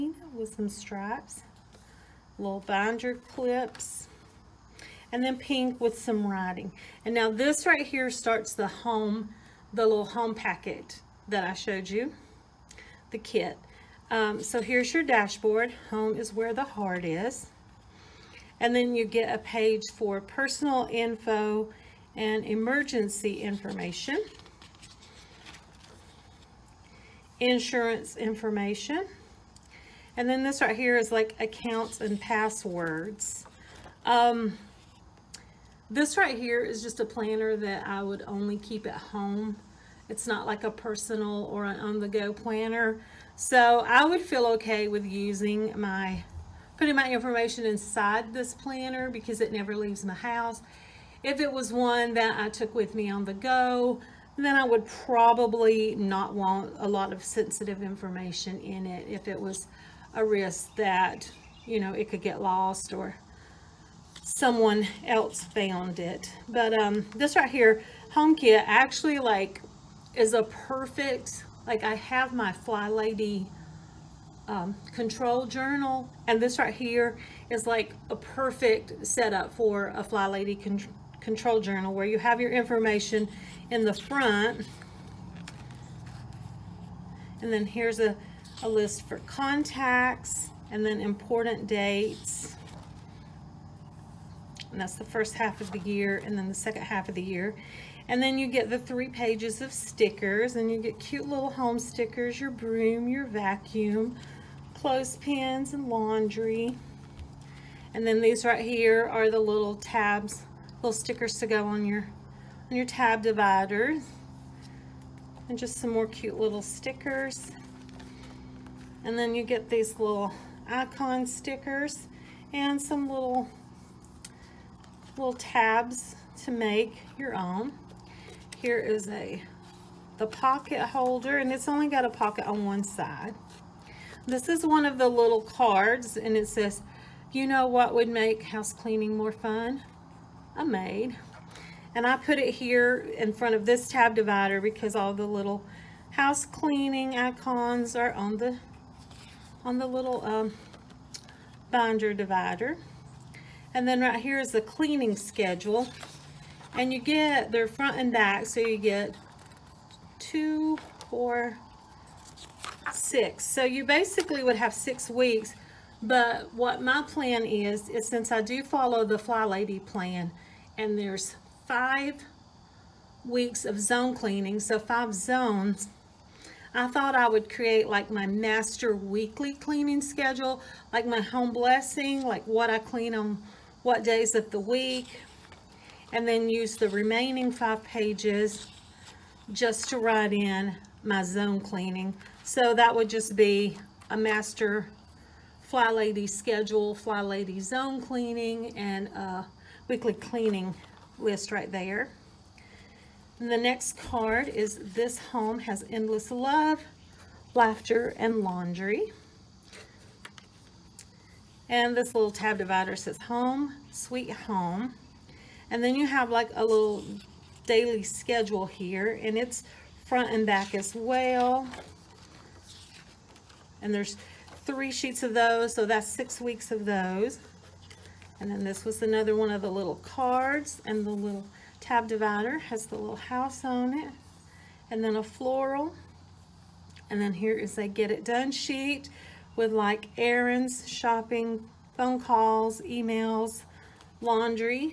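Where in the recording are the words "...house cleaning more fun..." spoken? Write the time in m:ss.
2:18.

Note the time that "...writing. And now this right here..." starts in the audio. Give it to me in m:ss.
0:06.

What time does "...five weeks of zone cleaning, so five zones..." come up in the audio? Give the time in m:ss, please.
2:51.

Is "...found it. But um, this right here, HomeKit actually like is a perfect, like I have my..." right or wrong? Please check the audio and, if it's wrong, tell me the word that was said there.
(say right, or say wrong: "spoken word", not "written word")
right.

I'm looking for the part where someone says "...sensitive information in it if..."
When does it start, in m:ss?
0:57.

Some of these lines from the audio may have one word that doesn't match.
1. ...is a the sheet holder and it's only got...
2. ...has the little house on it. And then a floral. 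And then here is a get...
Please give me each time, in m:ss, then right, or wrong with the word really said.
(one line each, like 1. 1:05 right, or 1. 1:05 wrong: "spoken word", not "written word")
1. 2:08 wrong: "pocket", not "sheet"
2. 3:52 right.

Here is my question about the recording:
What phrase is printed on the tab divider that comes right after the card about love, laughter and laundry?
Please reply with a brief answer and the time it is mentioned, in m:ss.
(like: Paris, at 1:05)
Home, Sweet Home, at 3:33.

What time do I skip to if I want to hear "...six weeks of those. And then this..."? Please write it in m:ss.
3:46.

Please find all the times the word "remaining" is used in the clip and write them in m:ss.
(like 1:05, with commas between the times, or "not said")
3:06.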